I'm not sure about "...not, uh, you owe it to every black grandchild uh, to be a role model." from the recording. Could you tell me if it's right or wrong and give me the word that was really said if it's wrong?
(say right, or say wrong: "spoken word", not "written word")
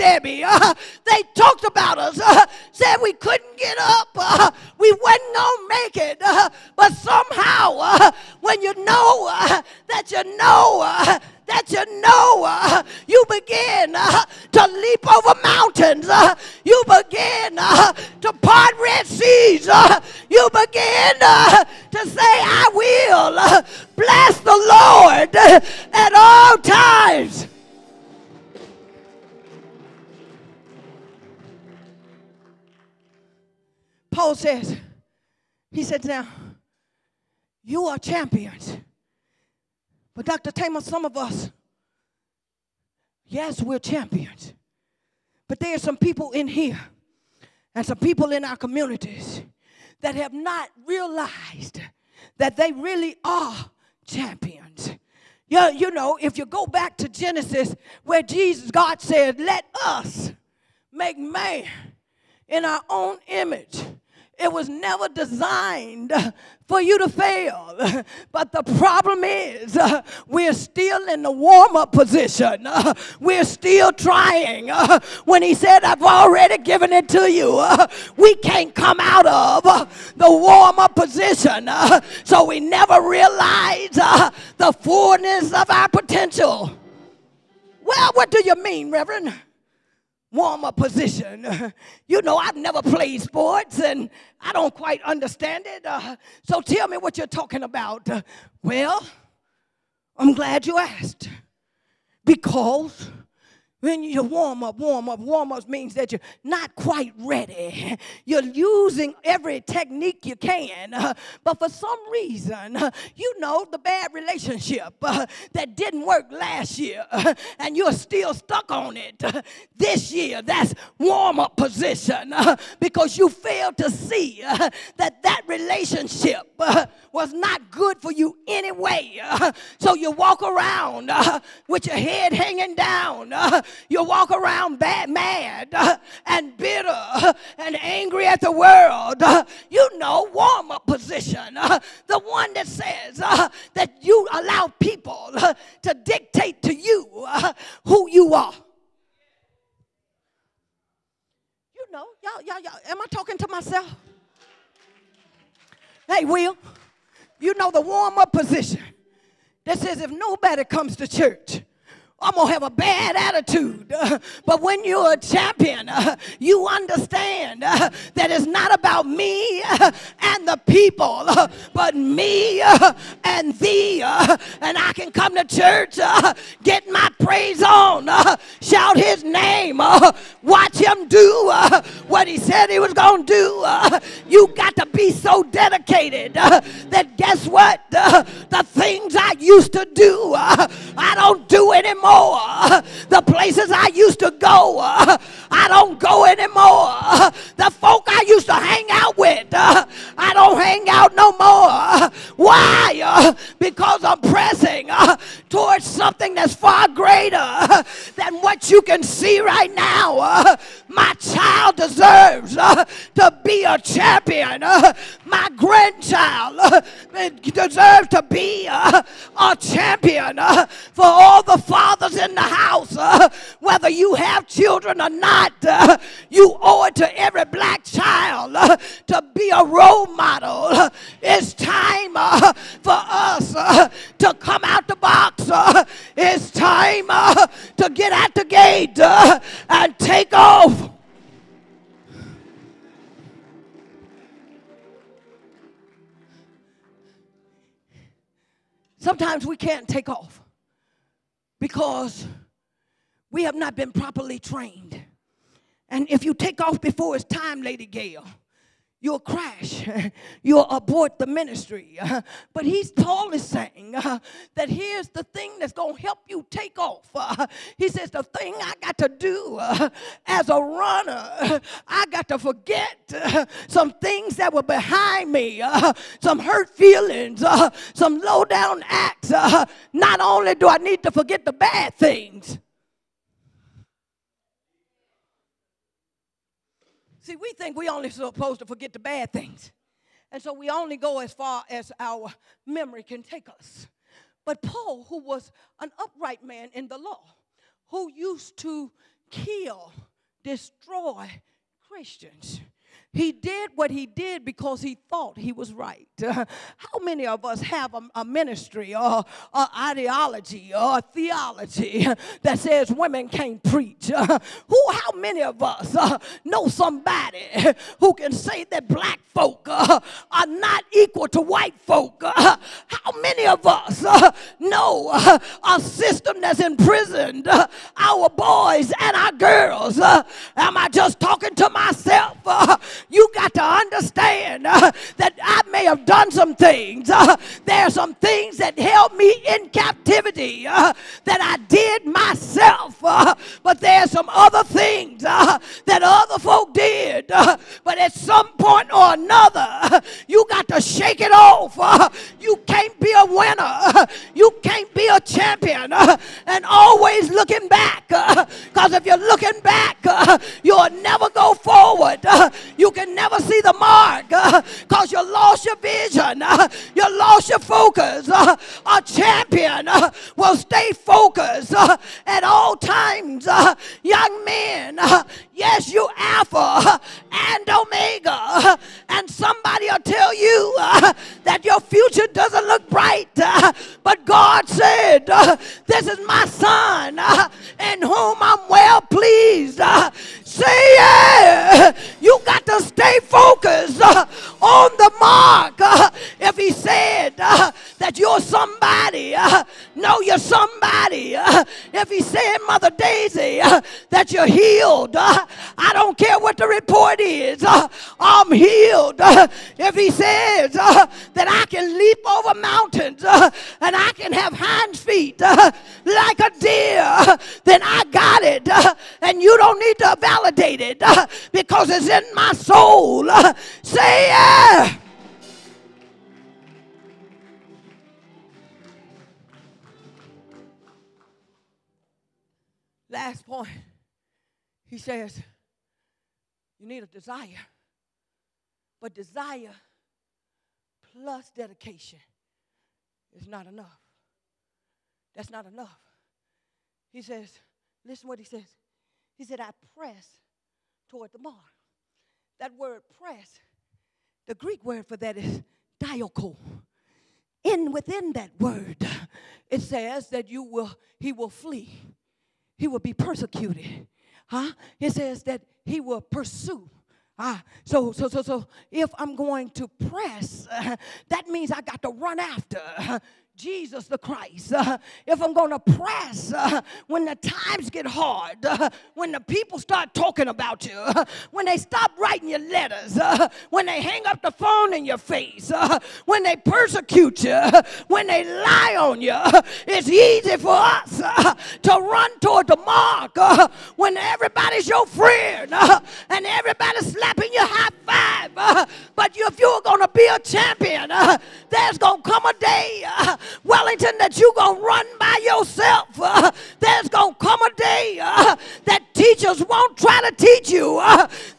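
wrong: "child", not "grandchild".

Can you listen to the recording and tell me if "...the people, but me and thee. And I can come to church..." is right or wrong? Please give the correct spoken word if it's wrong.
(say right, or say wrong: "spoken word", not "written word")
right.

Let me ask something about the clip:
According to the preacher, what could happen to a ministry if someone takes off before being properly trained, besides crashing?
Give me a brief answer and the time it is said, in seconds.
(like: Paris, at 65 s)
Abort the ministry, at 260 s.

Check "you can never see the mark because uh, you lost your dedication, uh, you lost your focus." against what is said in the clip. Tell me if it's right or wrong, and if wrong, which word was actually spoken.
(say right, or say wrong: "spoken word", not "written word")
wrong: "vision", not "dedication".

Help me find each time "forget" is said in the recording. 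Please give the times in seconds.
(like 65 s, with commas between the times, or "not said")
272 s, 281 s, 288 s.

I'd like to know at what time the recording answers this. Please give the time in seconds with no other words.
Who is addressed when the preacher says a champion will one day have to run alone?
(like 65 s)
503 s.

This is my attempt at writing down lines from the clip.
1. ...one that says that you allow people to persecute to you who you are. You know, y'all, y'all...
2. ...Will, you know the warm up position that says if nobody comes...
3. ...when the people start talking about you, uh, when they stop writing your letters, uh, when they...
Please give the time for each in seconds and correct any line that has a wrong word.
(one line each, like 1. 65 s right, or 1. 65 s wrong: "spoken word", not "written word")
1. 142 s wrong: "dictate", not "persecute"
2. 156 s right
3. 479 s right.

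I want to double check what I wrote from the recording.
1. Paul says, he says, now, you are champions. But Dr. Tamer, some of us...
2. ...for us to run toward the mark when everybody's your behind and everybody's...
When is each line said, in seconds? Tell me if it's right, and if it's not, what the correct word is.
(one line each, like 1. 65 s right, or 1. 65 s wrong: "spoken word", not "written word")
1. 34 s right
2. 490 s wrong: "friend", not "behind".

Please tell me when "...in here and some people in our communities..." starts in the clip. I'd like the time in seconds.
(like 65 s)
46 s.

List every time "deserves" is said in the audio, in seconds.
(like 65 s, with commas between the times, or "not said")
211 s, 217 s.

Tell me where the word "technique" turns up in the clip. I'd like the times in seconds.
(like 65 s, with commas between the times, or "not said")
109 s.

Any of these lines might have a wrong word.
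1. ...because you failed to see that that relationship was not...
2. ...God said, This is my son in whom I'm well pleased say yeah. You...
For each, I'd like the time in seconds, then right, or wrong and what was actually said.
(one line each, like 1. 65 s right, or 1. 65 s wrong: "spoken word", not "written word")
1. 122 s right
2. 384 s right.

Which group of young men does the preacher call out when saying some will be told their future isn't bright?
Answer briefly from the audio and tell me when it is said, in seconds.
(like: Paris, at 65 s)
Alpha and Omega, at 376 s.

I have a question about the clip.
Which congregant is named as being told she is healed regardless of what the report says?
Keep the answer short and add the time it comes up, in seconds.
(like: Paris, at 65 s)
Mother Daisy, at 402 s.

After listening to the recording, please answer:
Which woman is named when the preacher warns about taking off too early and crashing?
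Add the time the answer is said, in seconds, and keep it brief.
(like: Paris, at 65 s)
Lady Gail, at 257 s.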